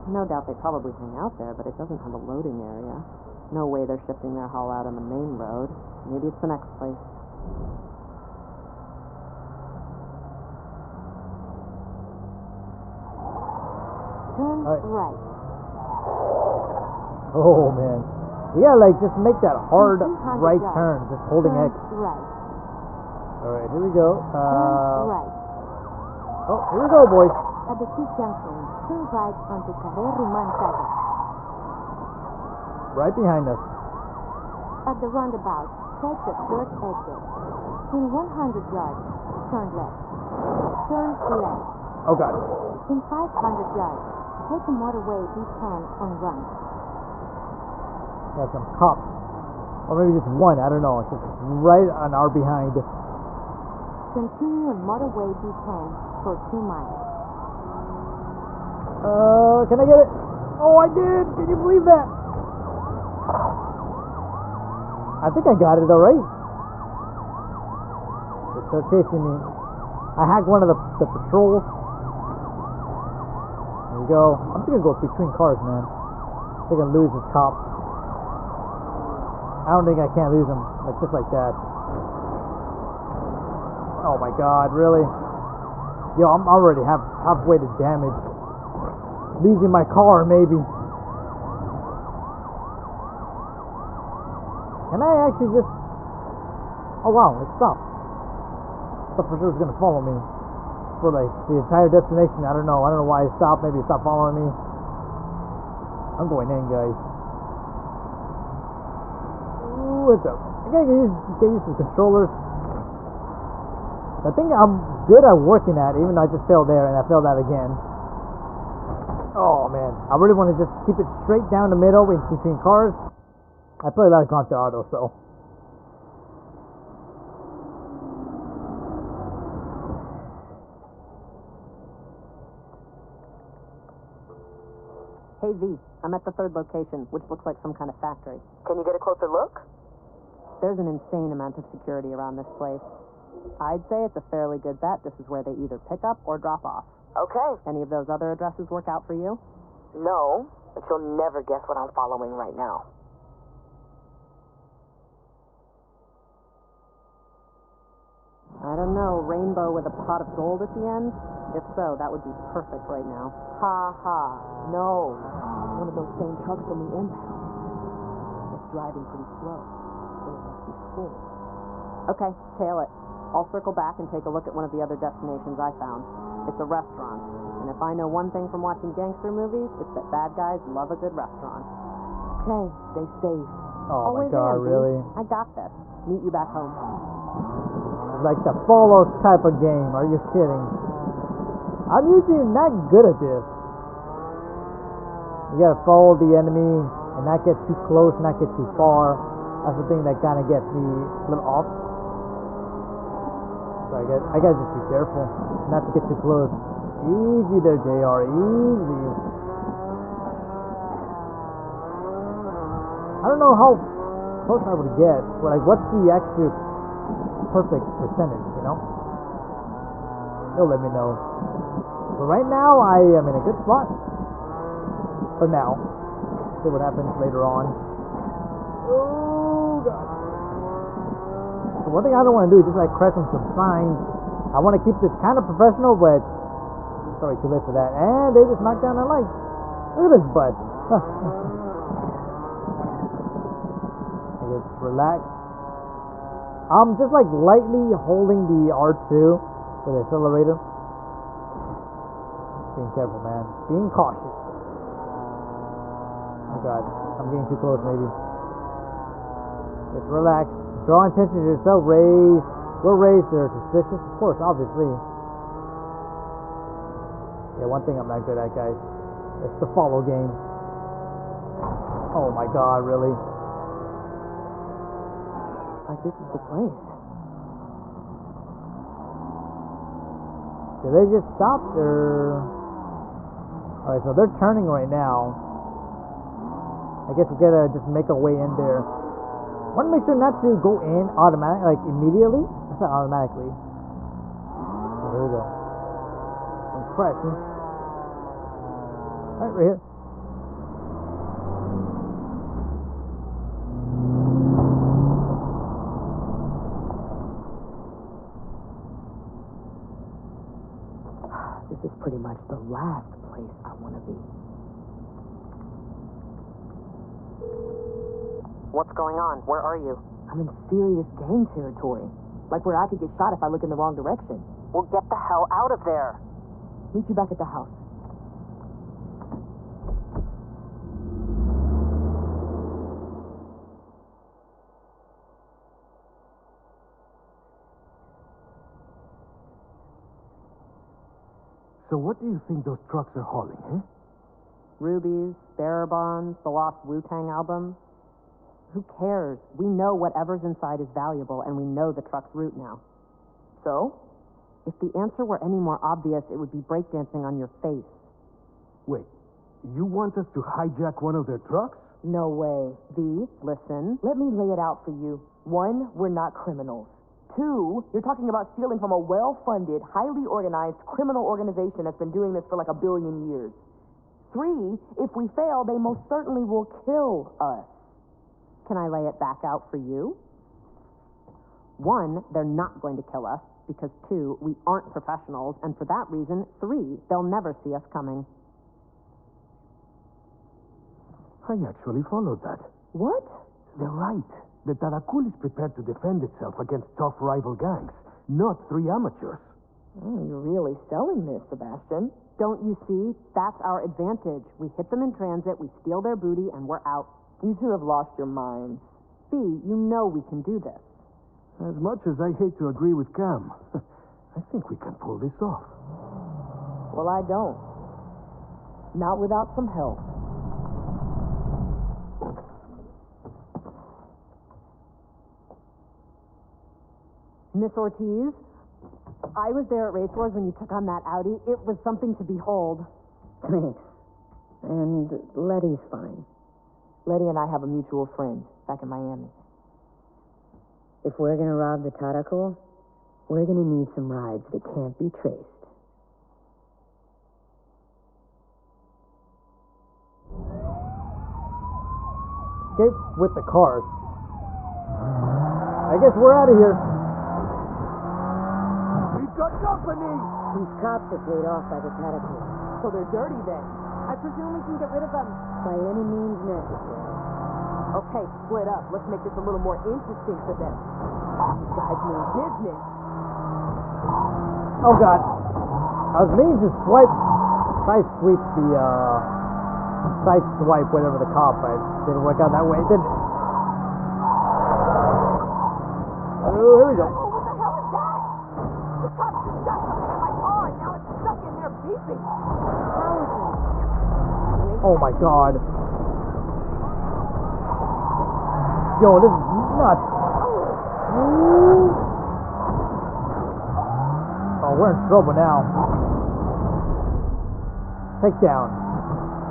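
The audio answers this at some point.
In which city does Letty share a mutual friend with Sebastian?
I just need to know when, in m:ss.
7:18.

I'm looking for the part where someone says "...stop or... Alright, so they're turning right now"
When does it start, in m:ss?
4:41.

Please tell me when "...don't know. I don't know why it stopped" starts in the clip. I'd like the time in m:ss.
1:42.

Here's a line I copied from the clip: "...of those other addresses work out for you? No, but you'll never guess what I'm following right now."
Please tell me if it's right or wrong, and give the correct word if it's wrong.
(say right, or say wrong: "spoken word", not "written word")
right.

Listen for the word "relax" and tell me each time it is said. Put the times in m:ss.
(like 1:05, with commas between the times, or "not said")
4:04, 4:20.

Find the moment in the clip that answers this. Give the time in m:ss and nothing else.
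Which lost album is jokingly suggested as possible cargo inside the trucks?
5:46.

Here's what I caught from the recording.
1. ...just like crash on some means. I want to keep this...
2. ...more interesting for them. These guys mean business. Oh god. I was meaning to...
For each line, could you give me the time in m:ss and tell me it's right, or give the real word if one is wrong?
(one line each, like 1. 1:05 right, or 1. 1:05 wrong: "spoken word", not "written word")
1. 3:52 wrong: "signs", not "means"
2. 7:49 right.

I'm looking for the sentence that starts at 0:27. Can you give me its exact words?
At the T junction, turn right onto Carrer Roman Casas.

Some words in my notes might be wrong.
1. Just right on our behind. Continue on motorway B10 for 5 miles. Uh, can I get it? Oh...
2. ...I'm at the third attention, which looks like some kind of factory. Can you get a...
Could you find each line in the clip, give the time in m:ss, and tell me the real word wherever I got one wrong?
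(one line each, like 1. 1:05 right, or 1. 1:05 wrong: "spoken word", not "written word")
1. 0:51 wrong: "2", not "5"
2. 2:16 wrong: "location", not "attention".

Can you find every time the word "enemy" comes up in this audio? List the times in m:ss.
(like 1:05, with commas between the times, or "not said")
3:16.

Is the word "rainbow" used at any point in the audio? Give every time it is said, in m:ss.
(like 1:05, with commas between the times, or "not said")
2:39.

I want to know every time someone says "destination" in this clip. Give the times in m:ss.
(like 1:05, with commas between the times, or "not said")
1:41, 2:54.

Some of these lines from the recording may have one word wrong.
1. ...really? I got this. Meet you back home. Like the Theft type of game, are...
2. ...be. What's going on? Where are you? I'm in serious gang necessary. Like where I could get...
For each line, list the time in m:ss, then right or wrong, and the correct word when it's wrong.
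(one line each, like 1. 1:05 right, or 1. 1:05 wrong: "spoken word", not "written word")
1. 3:04 wrong: "Fallout", not "Theft"
2. 5:14 wrong: "territory", not "necessary".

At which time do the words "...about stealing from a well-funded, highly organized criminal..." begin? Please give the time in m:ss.
6:08.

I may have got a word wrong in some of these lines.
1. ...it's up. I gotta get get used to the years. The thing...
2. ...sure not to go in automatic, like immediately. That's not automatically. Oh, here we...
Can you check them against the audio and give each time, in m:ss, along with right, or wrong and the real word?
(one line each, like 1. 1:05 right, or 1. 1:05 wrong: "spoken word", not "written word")
1. 1:50 wrong: "controllers", not "years"
2. 4:50 right.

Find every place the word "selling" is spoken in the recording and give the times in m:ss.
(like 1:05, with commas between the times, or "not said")
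6:40.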